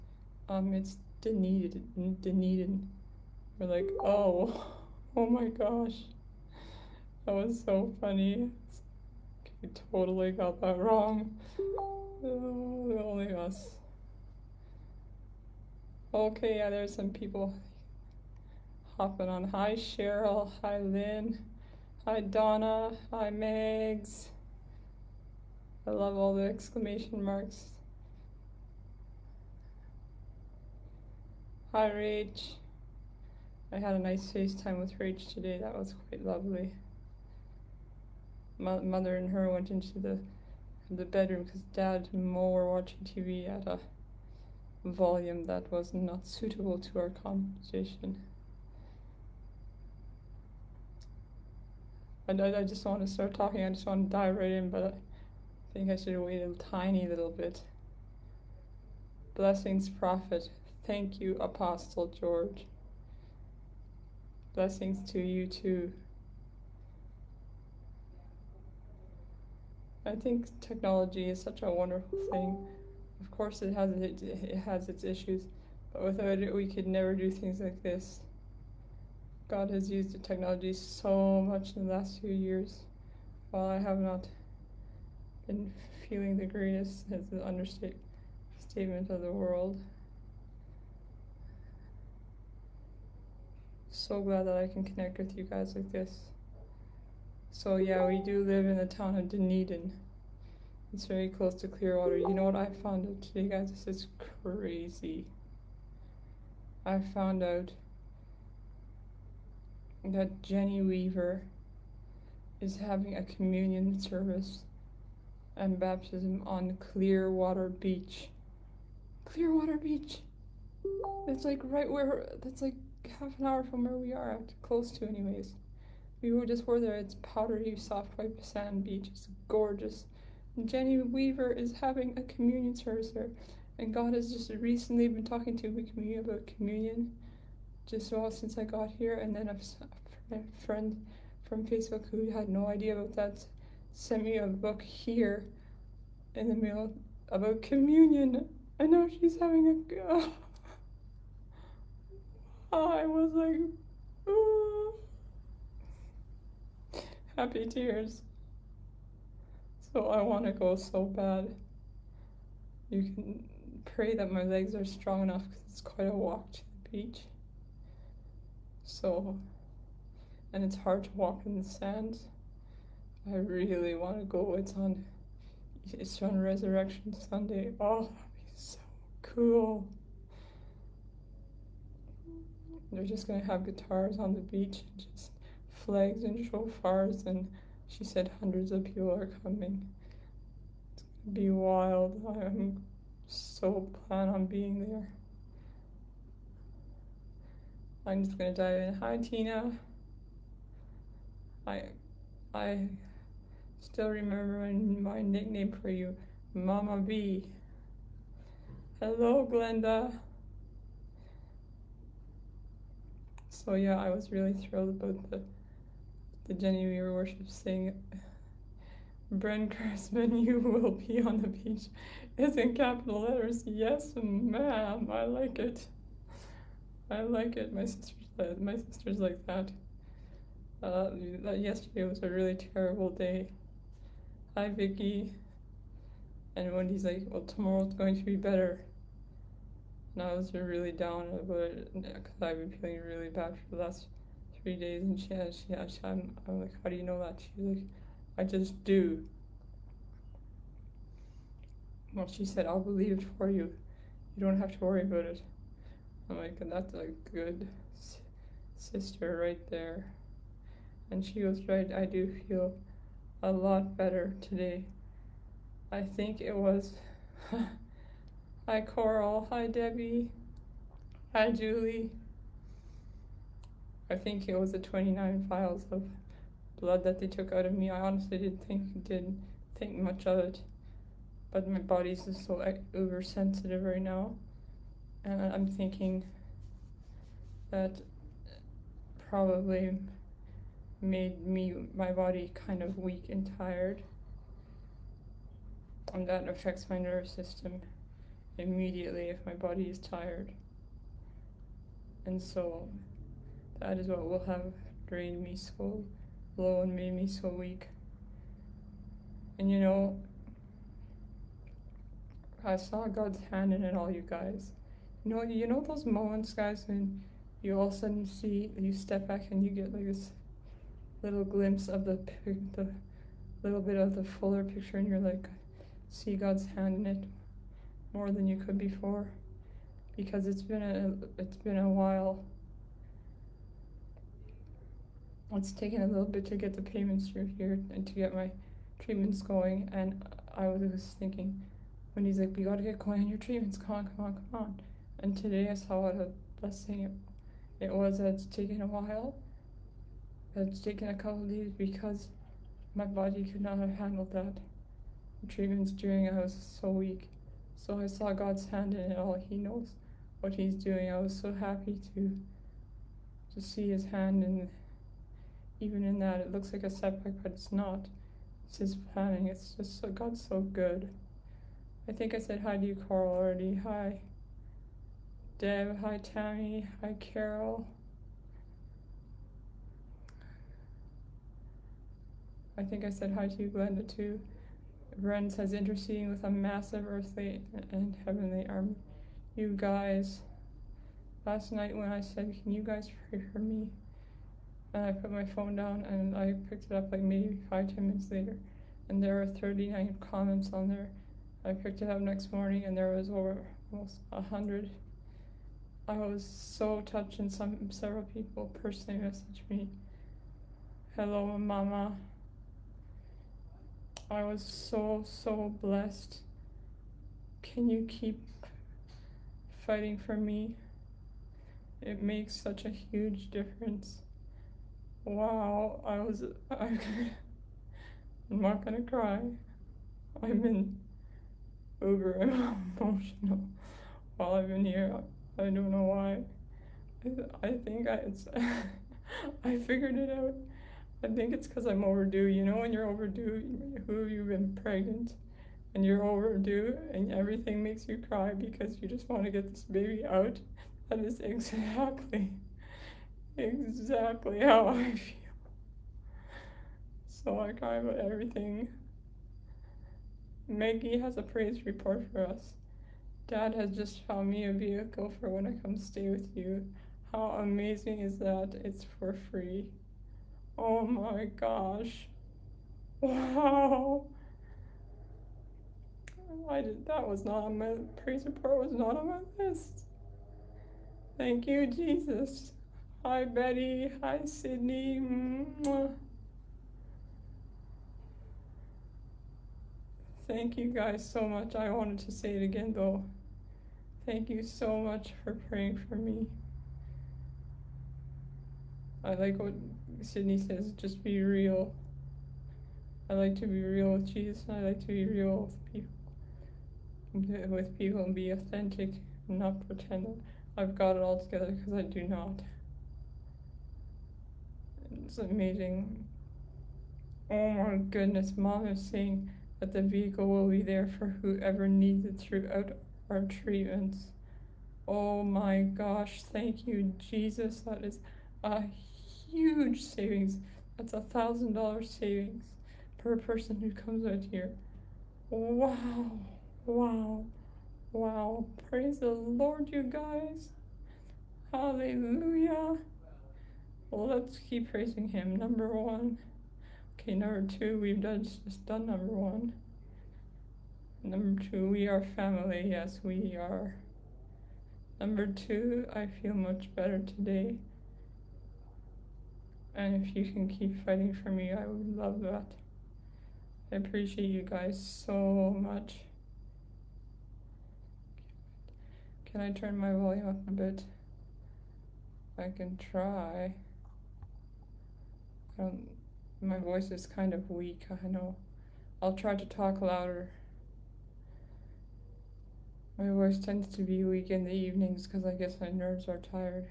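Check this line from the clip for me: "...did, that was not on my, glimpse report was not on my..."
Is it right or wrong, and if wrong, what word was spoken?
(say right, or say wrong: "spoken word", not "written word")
wrong: "praise", not "glimpse".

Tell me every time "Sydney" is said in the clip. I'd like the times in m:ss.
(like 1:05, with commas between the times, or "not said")
8:04, 8:20.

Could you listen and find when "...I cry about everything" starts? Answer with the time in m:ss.
7:37.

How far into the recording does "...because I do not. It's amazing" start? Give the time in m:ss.
8:31.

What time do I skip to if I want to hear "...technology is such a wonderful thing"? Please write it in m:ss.
1:10.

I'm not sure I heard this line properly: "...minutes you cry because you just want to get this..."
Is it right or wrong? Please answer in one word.
wrong.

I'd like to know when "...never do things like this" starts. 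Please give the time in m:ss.
1:16.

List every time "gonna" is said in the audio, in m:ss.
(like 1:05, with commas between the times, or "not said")
3:03, 3:11, 3:18, 7:08.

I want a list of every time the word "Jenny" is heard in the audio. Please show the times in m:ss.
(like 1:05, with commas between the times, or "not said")
1:50, 2:10, 3:36.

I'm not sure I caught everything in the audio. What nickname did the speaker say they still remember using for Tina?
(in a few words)
Mama B.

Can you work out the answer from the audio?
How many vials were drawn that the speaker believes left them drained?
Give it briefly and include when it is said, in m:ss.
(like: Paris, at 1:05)
29, at 4:34.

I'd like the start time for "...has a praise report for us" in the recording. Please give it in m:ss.
7:41.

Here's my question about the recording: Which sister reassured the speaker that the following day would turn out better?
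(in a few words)
Wendy.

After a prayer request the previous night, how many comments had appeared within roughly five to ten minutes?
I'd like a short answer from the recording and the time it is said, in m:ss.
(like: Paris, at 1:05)
39, at 6:39.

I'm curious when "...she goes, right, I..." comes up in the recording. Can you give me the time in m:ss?
4:21.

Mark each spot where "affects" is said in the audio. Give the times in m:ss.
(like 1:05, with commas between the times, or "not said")
4:56.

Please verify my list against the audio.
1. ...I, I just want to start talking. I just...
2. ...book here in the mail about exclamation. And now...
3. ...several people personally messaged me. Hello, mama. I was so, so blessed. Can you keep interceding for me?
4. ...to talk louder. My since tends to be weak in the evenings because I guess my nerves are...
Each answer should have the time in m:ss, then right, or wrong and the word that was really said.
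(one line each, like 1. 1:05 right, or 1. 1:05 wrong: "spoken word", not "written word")
1. 0:52 right
2. 2:24 wrong: "communion", not "exclamation"
3. 6:47 wrong: "fighting", not "interceding"
4. 9:39 wrong: "voice", not "since".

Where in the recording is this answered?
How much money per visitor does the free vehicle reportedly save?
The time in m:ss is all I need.
8:51.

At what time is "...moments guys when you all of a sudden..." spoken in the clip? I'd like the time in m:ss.
5:16.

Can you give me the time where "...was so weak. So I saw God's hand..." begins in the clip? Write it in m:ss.
5:56.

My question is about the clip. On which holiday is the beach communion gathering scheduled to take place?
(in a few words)
Resurrection Sunday.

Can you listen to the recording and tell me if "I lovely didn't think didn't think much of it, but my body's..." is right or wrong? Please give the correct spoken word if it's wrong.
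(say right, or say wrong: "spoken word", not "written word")
wrong: "honestly", not "lovely".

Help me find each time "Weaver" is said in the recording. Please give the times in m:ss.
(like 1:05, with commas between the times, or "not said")
1:50, 2:10, 3:36.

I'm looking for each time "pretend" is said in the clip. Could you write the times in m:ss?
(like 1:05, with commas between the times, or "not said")
8:29.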